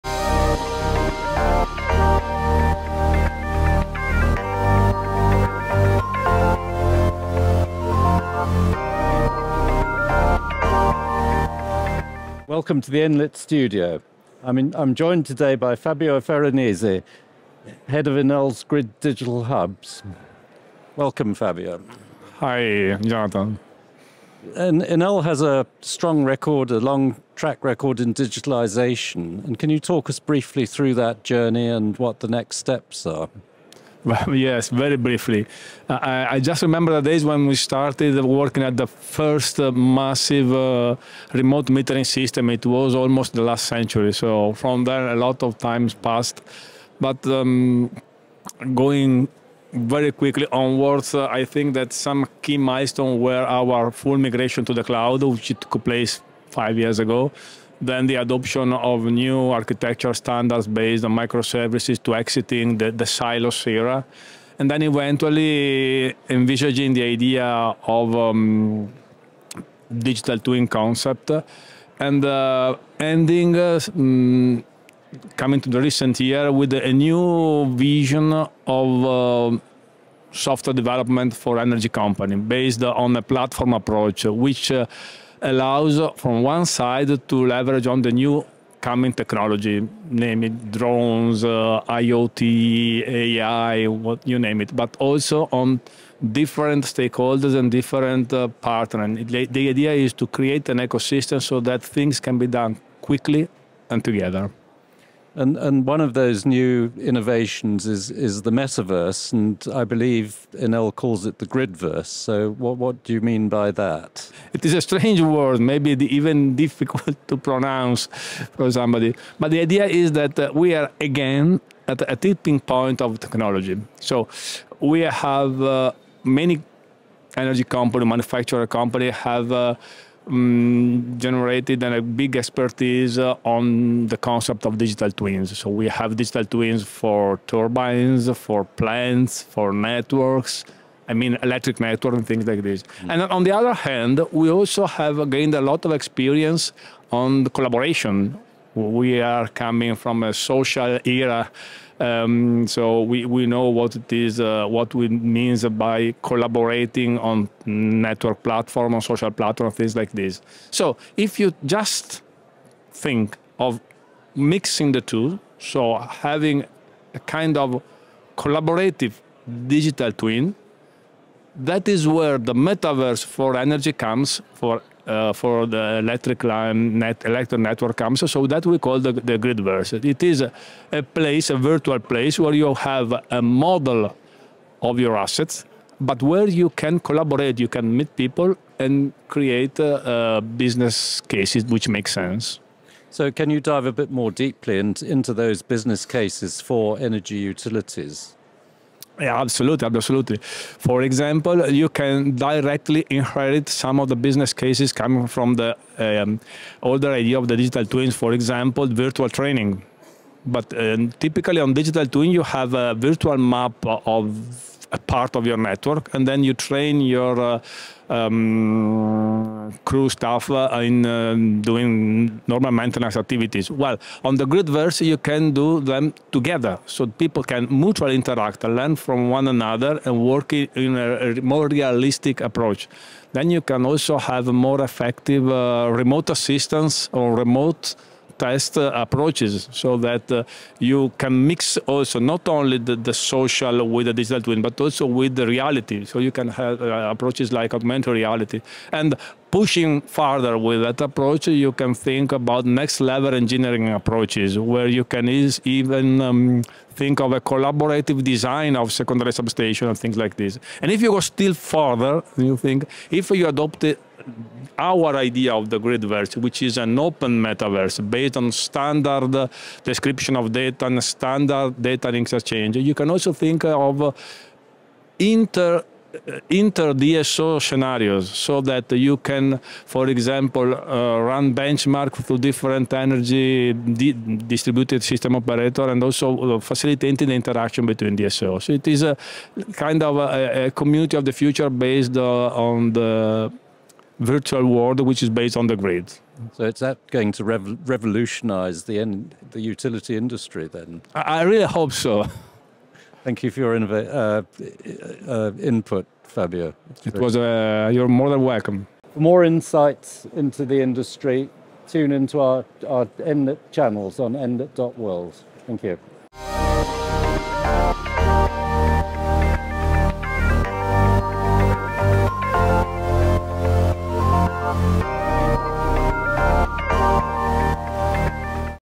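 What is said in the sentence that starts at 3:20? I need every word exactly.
For example, you can directly inherit some of the business cases coming from the um, older idea of the digital twins.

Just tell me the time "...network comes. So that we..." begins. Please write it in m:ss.
2:57.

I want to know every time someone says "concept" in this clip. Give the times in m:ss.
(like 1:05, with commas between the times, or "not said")
1:10, 2:14.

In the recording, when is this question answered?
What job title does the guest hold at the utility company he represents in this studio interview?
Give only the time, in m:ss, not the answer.
0:17.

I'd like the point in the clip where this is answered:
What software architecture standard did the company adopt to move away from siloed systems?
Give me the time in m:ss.
1:01.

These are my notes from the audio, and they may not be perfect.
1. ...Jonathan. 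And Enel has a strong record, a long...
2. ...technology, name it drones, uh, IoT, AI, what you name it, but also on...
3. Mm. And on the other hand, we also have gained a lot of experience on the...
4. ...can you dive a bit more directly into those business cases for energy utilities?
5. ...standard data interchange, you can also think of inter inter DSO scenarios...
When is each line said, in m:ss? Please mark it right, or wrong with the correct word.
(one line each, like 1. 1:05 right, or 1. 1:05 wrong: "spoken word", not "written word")
1. 0:23 right
2. 1:29 right
3. 2:22 right
4. 3:13 wrong: "deeply", not "directly"
5. 4:31 right.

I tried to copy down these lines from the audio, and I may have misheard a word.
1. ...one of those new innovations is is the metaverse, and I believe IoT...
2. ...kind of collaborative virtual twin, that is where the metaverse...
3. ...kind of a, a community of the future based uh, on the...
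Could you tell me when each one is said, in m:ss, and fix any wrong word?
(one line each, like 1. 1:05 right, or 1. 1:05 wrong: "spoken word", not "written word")
1. 1:45 wrong: "Enel", not "IoT"
2. 2:47 wrong: "digital", not "virtual"
3. 4:49 right.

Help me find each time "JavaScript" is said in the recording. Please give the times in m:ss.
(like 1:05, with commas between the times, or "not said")
not said.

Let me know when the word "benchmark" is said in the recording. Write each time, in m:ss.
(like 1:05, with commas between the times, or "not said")
4:41.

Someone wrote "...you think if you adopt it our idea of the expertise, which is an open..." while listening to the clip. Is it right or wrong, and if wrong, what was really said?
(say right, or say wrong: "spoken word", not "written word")
wrong: "gridverse", not "expertise".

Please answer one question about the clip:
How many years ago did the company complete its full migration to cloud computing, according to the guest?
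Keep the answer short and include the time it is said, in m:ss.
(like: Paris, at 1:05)
5, at 0:56.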